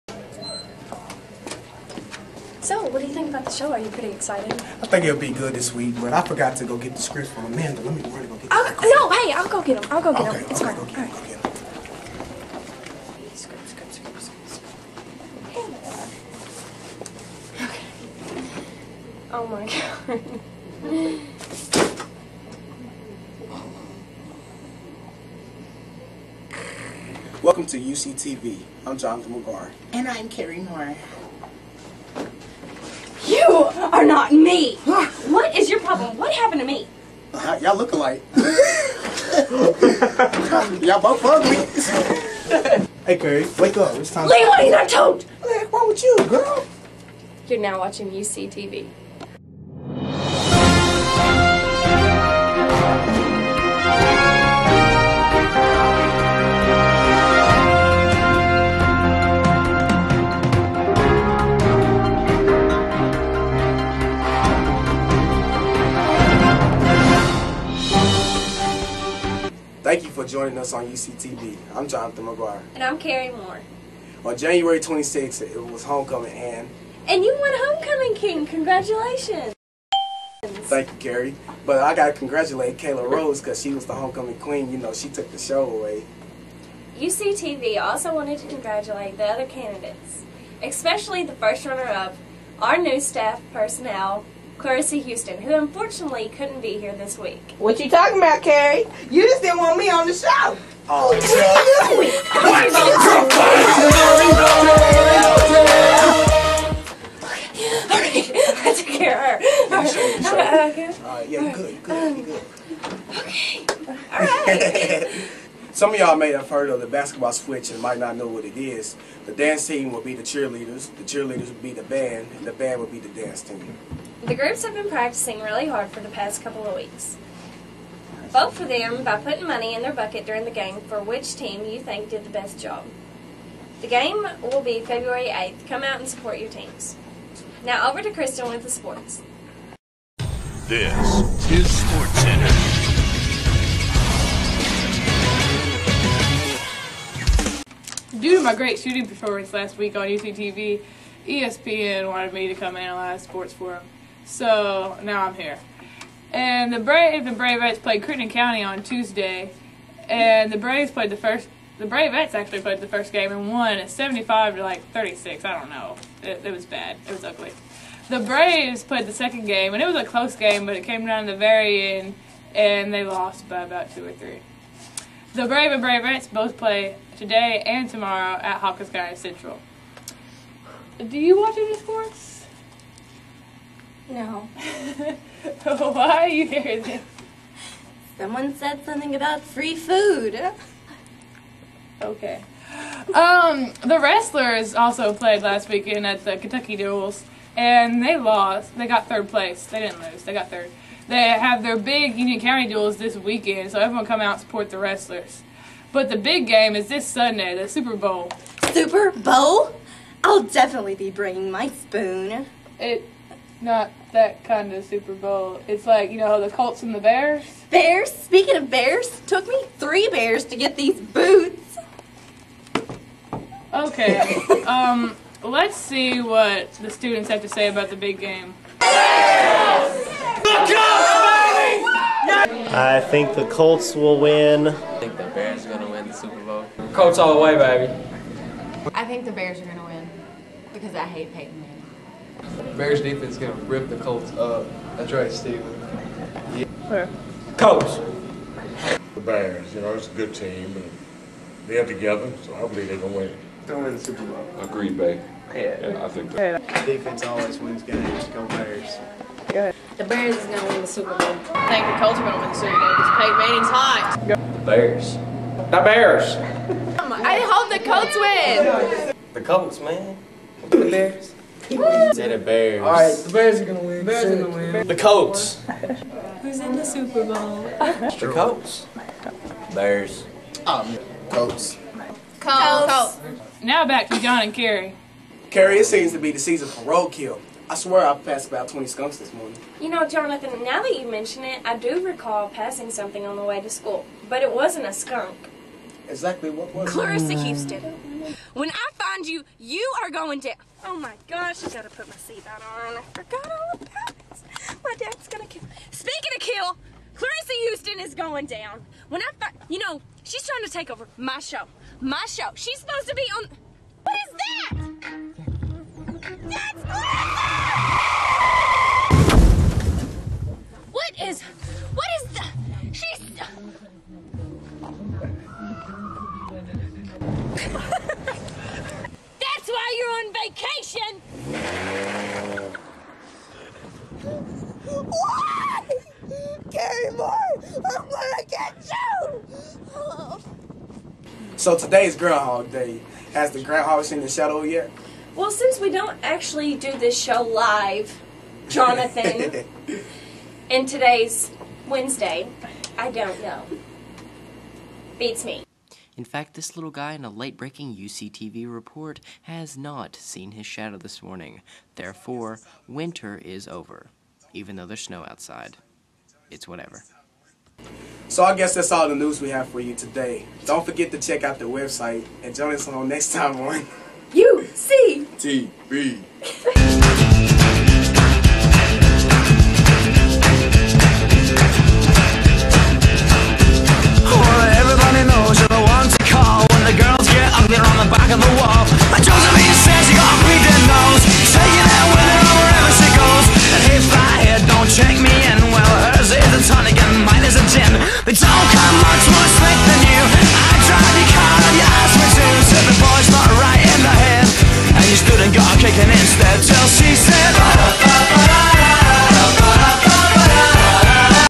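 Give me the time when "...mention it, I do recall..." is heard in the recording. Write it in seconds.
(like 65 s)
291 s.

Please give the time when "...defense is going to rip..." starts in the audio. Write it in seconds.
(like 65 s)
243 s.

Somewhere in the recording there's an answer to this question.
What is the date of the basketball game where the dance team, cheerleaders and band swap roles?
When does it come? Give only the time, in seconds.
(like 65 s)
134 s.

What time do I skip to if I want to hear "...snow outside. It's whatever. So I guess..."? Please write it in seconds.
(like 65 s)
365 s.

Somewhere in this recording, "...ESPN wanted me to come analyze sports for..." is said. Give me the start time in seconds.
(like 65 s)
151 s.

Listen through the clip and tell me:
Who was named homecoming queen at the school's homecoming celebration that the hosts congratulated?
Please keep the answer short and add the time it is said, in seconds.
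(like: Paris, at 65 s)
Kayla Rose, at 82 s.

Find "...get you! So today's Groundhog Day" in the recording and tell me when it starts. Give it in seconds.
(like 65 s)
338 s.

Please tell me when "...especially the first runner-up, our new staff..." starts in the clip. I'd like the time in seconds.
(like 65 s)
90 s.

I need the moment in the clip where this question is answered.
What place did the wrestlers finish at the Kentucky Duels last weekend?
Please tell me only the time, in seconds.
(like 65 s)
199 s.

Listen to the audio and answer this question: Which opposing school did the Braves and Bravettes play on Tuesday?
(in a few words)
Crittenden County.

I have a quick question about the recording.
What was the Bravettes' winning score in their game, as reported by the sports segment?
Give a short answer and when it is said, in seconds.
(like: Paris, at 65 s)
75 to 36, at 163 s.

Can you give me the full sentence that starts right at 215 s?
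It's like, you know, the Colts and the Bears.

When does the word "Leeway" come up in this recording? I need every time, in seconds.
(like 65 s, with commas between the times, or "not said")
44 s.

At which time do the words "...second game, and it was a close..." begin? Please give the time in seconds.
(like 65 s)
169 s.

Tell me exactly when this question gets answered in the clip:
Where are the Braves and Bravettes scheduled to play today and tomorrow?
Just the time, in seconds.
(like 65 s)
178 s.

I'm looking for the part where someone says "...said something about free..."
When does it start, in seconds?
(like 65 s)
188 s.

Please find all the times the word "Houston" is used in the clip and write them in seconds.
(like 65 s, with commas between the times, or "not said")
94 s, 297 s, 307 s.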